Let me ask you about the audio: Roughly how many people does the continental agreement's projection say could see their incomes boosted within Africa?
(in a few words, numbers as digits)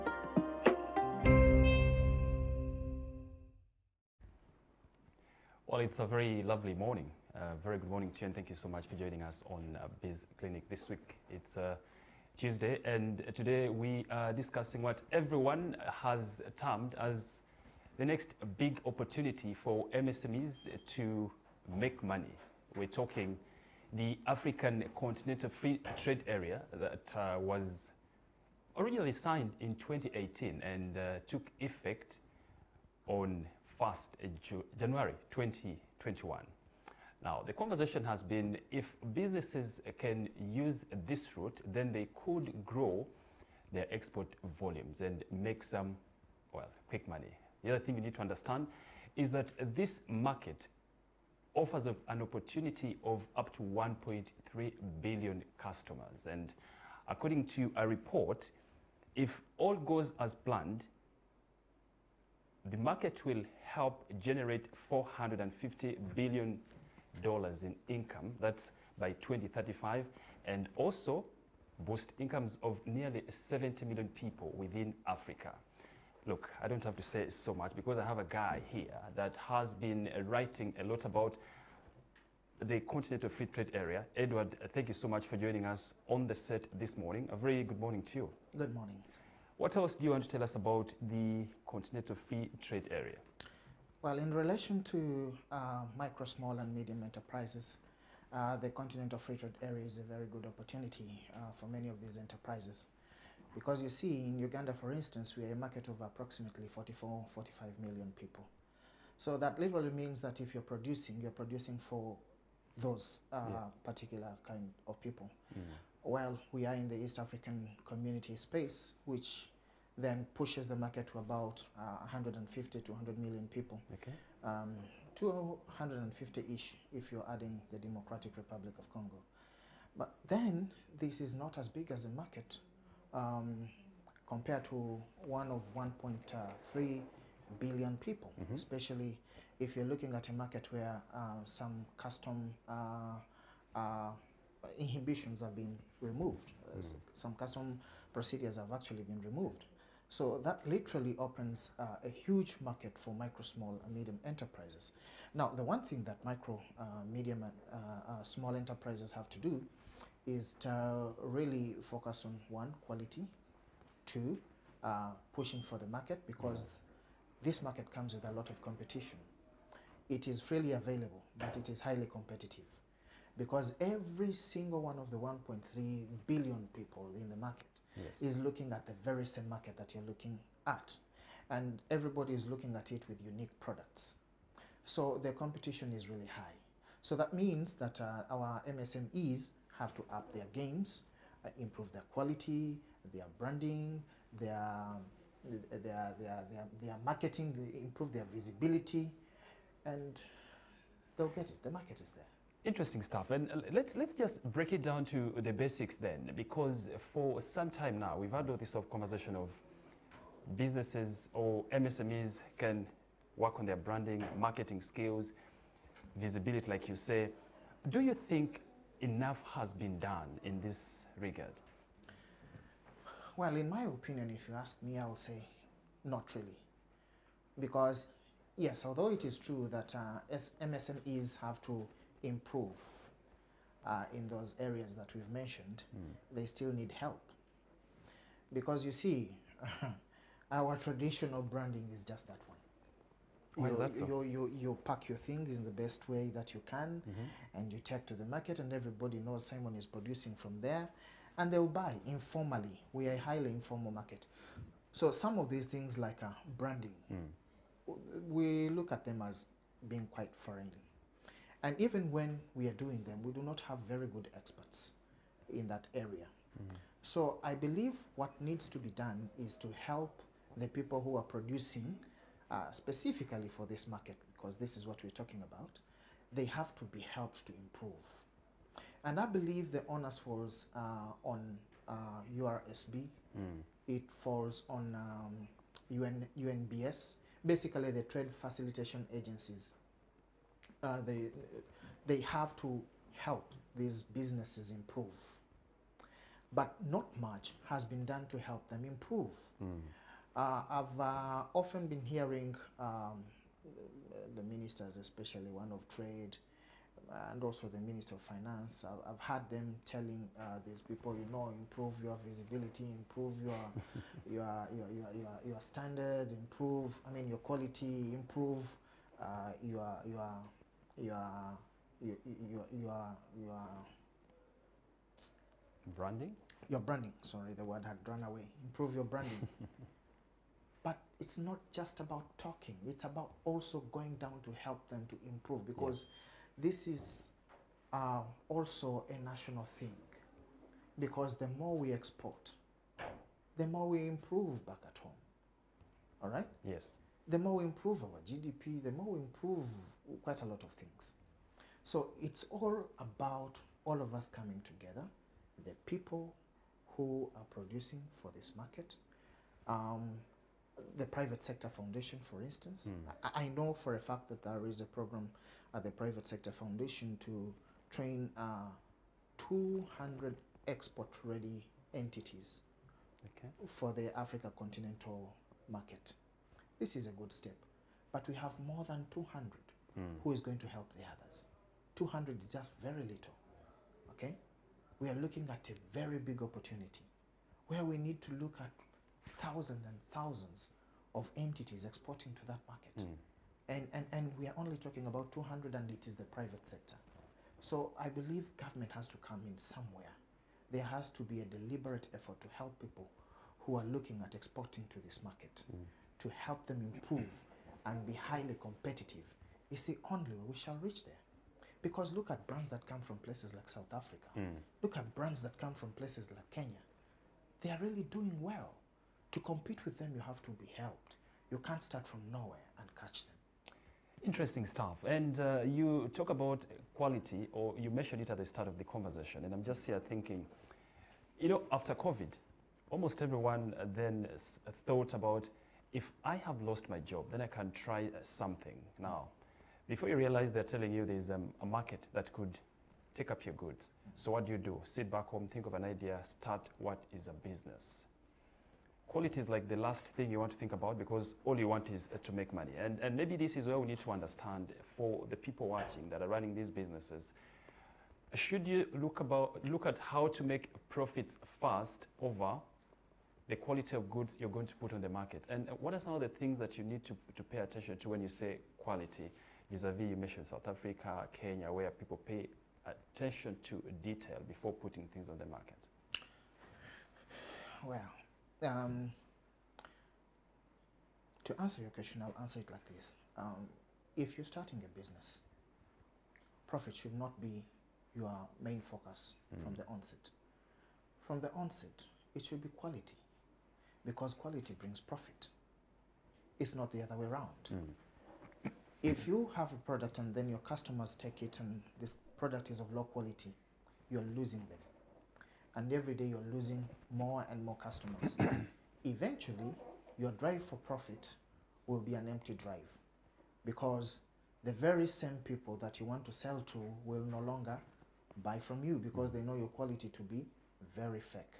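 70 million.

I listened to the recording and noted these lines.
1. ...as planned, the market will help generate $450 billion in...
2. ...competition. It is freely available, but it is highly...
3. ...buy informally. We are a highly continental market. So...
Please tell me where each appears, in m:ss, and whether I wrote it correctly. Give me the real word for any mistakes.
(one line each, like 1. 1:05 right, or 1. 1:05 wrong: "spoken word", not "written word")
1. 1:00 right
2. 2:48 right
3. 4:11 wrong: "informal", not "continental".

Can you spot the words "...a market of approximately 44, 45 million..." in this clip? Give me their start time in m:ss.
1:45.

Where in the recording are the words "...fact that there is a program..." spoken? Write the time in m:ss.
6:03.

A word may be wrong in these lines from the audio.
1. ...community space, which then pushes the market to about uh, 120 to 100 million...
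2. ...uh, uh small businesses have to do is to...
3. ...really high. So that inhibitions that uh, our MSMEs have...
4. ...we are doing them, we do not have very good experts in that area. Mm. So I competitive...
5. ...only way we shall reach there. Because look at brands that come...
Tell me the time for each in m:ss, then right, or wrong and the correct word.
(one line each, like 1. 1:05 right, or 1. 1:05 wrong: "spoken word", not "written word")
1. 1:57 wrong: "150", not "120"
2. 2:37 wrong: "enterprises", not "businesses"
3. 3:06 wrong: "means", not "inhibitions"
4. 4:22 wrong: "believe", not "competitive"
5. 6:50 right.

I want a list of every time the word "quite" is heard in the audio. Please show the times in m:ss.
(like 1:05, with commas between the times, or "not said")
4:20, 5:50.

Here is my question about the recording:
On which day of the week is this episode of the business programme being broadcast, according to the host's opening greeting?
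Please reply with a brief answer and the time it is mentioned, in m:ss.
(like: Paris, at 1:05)
Tuesday, at 0:12.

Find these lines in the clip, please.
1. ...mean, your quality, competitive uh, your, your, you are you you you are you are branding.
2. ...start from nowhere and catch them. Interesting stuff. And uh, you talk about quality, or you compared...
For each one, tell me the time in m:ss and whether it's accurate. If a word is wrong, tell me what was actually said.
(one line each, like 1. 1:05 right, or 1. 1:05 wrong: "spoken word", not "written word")
1. 5:17 wrong: "improve", not "competitive"
2. 7:01 wrong: "mentioned", not "compared".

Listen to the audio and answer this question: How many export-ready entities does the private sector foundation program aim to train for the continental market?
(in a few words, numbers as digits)
200.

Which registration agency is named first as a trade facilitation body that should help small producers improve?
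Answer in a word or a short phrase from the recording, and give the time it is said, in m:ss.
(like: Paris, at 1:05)
URSB, at 4:42.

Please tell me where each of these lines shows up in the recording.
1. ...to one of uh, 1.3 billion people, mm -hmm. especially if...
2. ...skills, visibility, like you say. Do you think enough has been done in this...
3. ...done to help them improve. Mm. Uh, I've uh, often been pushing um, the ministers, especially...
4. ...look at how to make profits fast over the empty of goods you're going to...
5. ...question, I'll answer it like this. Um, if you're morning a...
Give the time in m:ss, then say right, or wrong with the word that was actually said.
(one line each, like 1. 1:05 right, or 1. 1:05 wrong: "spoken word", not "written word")
1. 2:14 right
2. 3:34 right
3. 4:58 wrong: "hearing", not "pushing"
4. 7:39 wrong: "quality", not "empty"
5. 8:01 wrong: "starting", not "morning".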